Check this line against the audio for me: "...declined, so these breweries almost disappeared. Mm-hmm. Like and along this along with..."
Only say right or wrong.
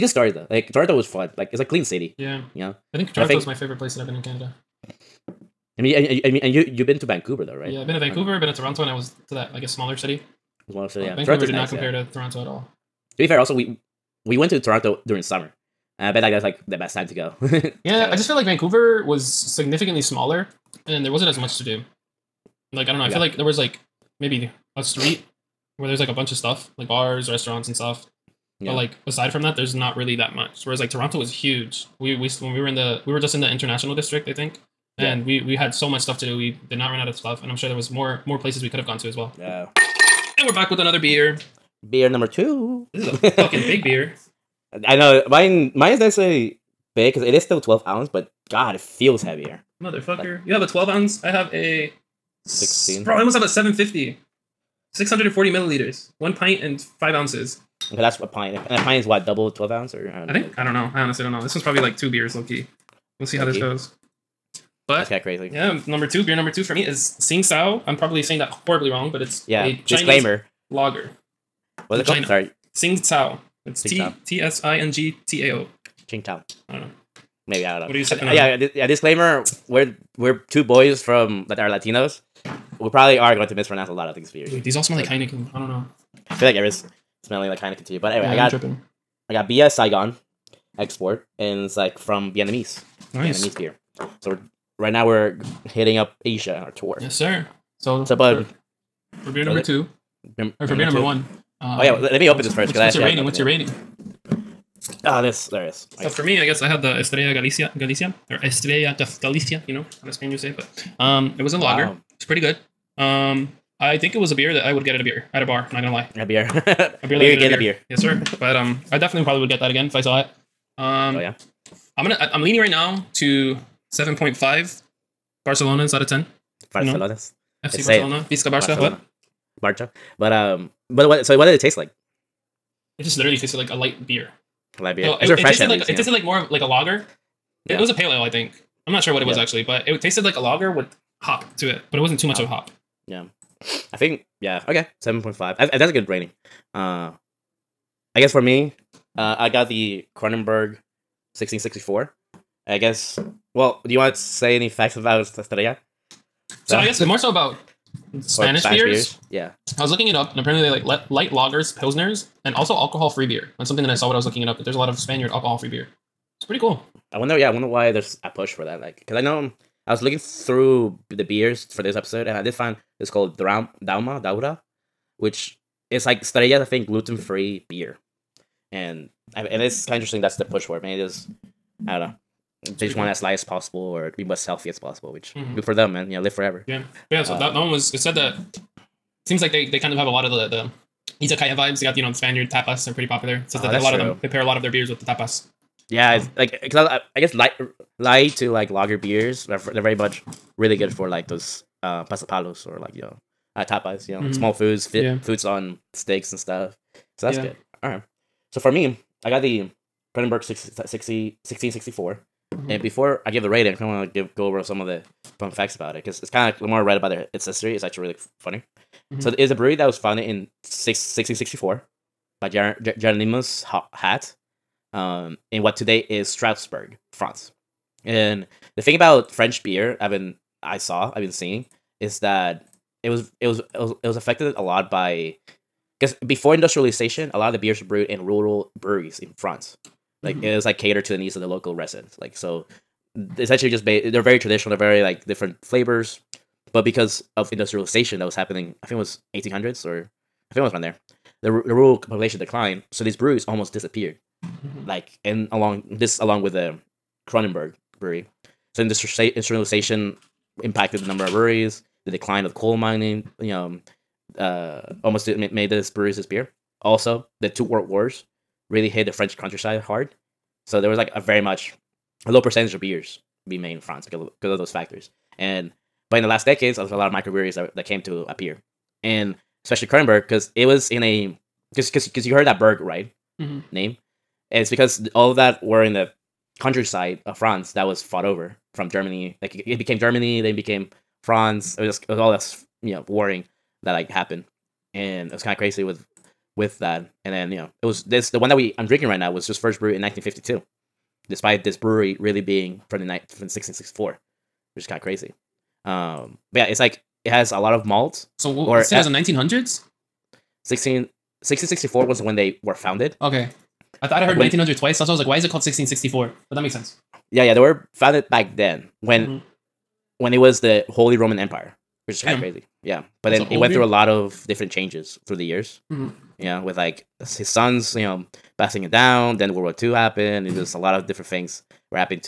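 right.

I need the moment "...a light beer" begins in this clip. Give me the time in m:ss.
2:13.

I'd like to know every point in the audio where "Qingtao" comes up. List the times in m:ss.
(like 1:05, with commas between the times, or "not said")
1:16.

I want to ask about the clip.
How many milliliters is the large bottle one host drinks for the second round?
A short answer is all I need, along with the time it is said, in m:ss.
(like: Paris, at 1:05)
640, at 0:54.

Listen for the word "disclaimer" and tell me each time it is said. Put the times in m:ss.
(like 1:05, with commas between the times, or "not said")
1:09, 1:18.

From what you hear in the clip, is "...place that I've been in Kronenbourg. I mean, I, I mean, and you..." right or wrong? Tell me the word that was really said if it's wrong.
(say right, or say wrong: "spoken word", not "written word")
wrong: "Canada", not "Kronenbourg".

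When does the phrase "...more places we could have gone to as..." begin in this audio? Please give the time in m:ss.
0:38.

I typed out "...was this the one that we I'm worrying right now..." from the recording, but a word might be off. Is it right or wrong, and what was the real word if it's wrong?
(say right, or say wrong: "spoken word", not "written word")
wrong: "drinking", not "worrying".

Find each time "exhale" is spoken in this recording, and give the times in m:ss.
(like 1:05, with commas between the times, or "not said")
not said.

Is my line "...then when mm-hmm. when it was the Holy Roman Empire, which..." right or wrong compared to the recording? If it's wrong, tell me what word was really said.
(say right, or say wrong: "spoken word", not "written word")
right.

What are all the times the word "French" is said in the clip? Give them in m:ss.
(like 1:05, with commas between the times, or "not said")
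3:49, 4:29.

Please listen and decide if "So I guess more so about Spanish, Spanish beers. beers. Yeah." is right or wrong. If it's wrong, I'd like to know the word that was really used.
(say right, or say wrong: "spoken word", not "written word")
right.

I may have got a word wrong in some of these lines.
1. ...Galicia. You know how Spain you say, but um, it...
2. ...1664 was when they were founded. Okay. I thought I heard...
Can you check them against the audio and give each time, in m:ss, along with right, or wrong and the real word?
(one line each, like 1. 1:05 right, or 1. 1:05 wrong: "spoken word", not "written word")
1. 1:49 right
2. 5:11 right.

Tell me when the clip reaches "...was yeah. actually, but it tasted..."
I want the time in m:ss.
2:19.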